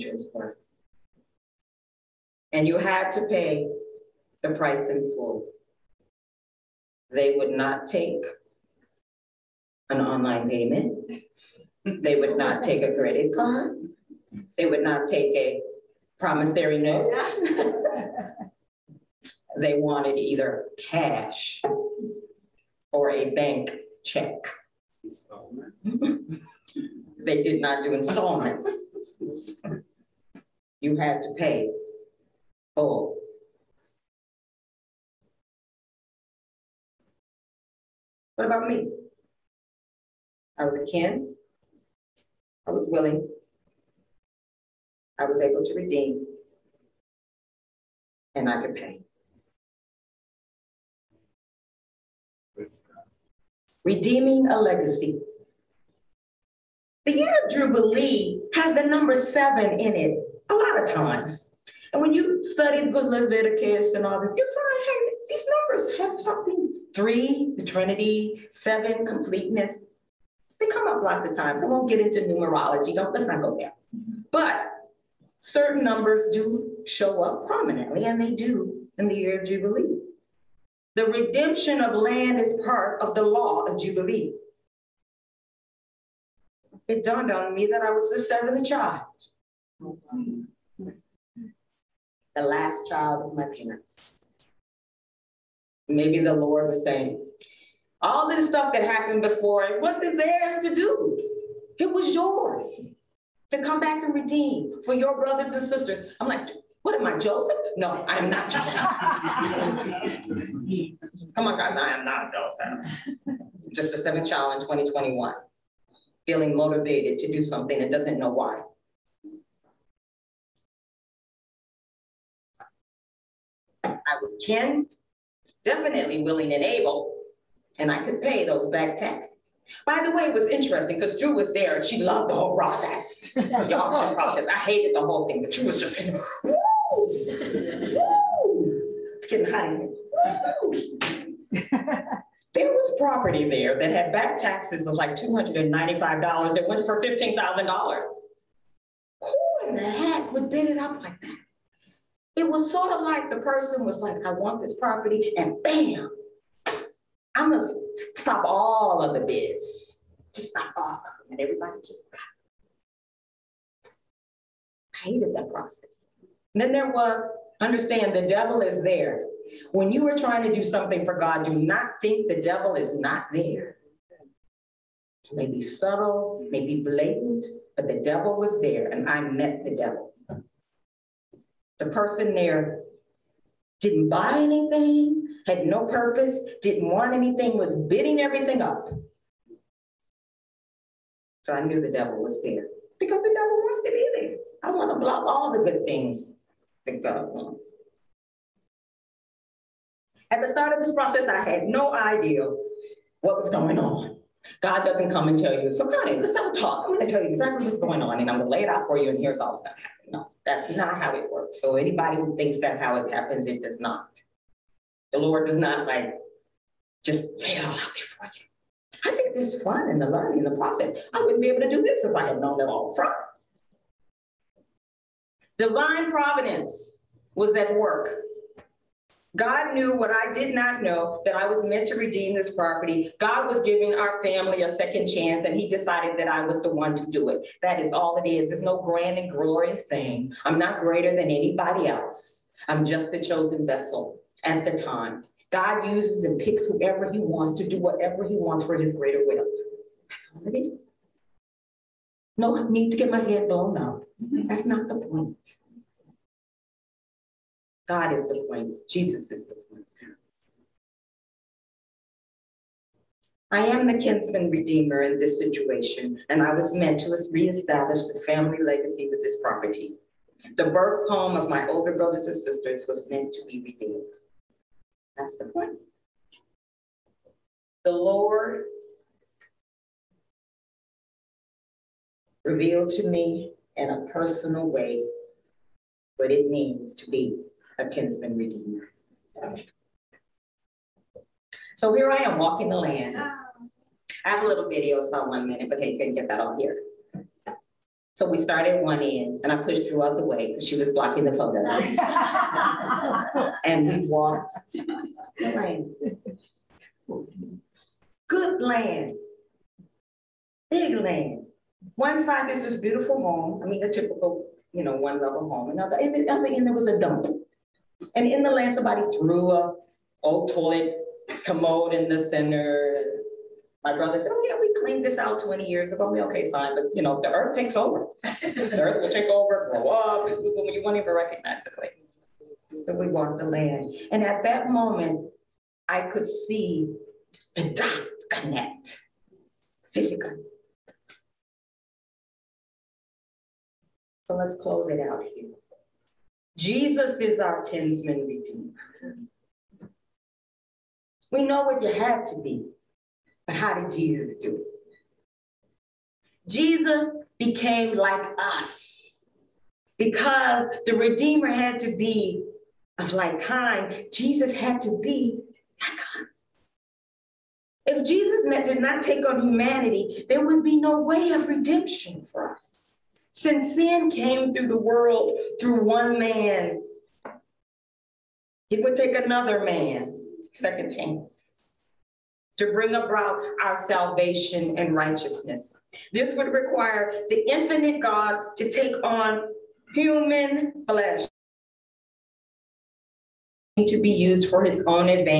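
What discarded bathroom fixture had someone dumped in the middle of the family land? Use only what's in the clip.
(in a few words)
toilet commode.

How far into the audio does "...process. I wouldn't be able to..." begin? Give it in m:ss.
3:40.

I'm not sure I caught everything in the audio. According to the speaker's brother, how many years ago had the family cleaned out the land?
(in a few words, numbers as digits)
20.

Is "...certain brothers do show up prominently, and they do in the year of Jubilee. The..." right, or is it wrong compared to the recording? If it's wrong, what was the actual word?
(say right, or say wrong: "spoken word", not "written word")
wrong: "numbers", not "brothers".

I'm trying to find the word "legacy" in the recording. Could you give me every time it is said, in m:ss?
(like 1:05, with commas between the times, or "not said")
0:54, 4:28.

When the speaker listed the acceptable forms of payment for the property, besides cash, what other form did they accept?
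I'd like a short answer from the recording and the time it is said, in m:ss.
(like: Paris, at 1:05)
bank check, at 0:23.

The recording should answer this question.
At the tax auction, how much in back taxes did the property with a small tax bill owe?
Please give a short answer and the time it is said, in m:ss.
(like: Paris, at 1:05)
$295, at 2:25.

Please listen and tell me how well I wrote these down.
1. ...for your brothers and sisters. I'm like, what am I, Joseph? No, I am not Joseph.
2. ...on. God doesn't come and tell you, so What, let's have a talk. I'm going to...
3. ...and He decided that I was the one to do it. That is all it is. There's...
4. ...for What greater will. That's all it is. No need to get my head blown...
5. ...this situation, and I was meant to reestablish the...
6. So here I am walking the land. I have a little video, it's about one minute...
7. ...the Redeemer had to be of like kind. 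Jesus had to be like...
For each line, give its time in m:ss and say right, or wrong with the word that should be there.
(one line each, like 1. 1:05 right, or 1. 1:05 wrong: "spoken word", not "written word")
1. 1:44 right
2. 3:23 wrong: "Connie", not "What"
3. 3:55 right
4. 4:08 wrong: "His", not "What"
5. 4:25 right
6. 4:51 right
7. 6:00 right.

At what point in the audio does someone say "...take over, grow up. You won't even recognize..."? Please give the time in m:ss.
5:29.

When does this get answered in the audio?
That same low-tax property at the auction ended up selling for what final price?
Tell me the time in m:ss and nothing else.
2:26.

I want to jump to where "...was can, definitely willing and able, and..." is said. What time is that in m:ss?
2:04.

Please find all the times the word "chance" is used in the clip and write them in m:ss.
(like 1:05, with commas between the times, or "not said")
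3:55, 6:20.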